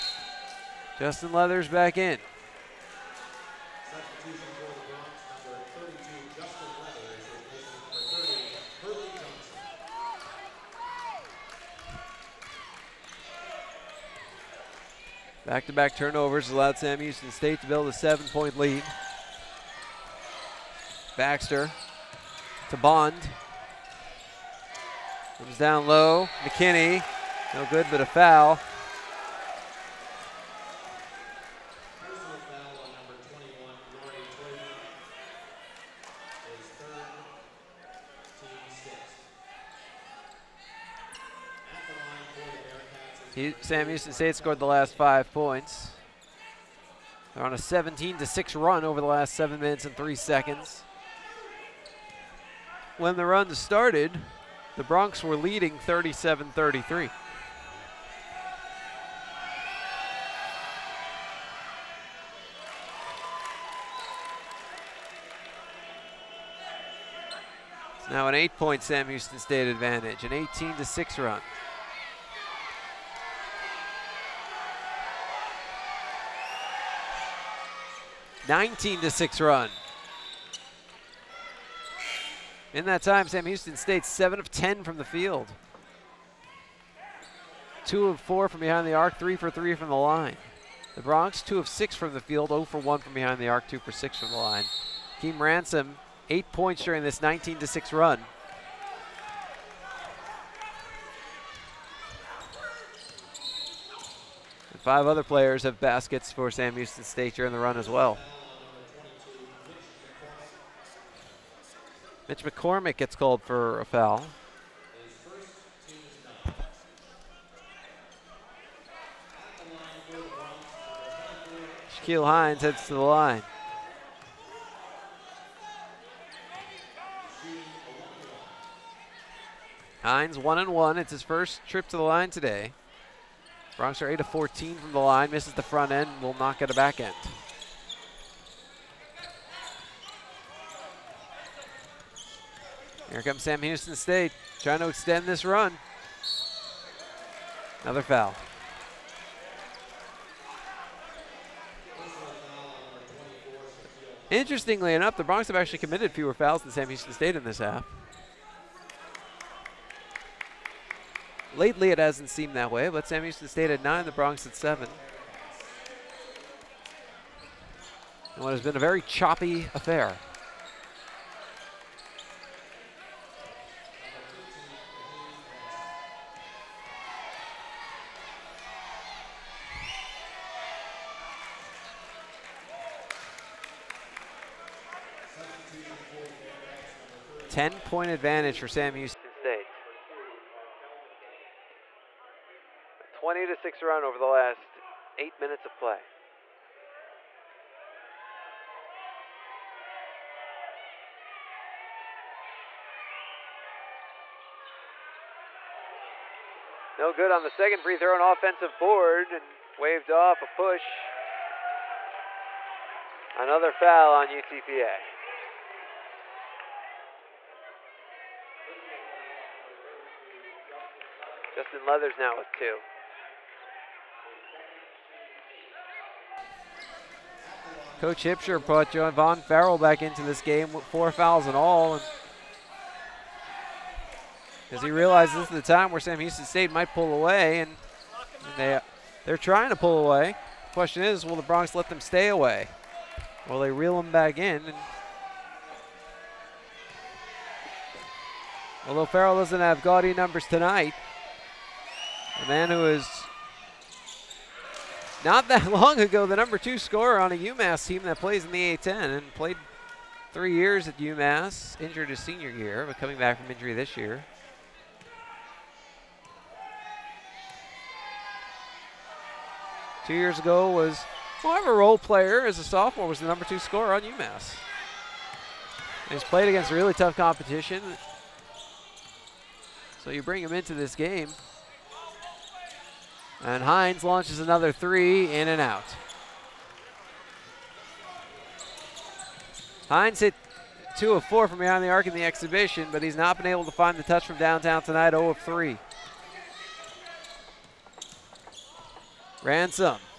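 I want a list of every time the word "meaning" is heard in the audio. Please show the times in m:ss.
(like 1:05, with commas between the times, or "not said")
not said.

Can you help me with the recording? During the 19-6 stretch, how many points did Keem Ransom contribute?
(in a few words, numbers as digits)
8.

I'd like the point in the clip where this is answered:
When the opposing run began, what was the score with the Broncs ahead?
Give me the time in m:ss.
0:55.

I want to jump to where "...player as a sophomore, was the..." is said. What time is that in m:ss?
4:31.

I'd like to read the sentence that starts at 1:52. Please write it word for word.
Mitch McCormick gets called for a foul.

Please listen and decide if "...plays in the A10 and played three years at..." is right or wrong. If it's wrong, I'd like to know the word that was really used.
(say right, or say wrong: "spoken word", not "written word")
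right.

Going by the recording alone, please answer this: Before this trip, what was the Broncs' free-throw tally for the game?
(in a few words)
8 of 14.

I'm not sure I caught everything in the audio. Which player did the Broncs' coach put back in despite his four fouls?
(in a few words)
Javon Farrell.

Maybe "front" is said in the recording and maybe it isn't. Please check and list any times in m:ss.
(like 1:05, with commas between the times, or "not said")
2:15.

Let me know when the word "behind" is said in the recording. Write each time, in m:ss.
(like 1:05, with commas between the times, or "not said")
1:28, 1:33, 4:51.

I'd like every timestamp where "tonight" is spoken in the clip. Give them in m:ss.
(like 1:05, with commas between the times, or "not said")
4:10, 4:54.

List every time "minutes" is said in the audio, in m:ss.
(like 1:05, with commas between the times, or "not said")
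0:49, 3:15.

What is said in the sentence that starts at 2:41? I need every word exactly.
Lately, it hasn't seemed that way, but Sam Houston State at 9, the Broncs at 7.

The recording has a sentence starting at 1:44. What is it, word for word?
five other players have baskets for Sam Houston State during the run as well.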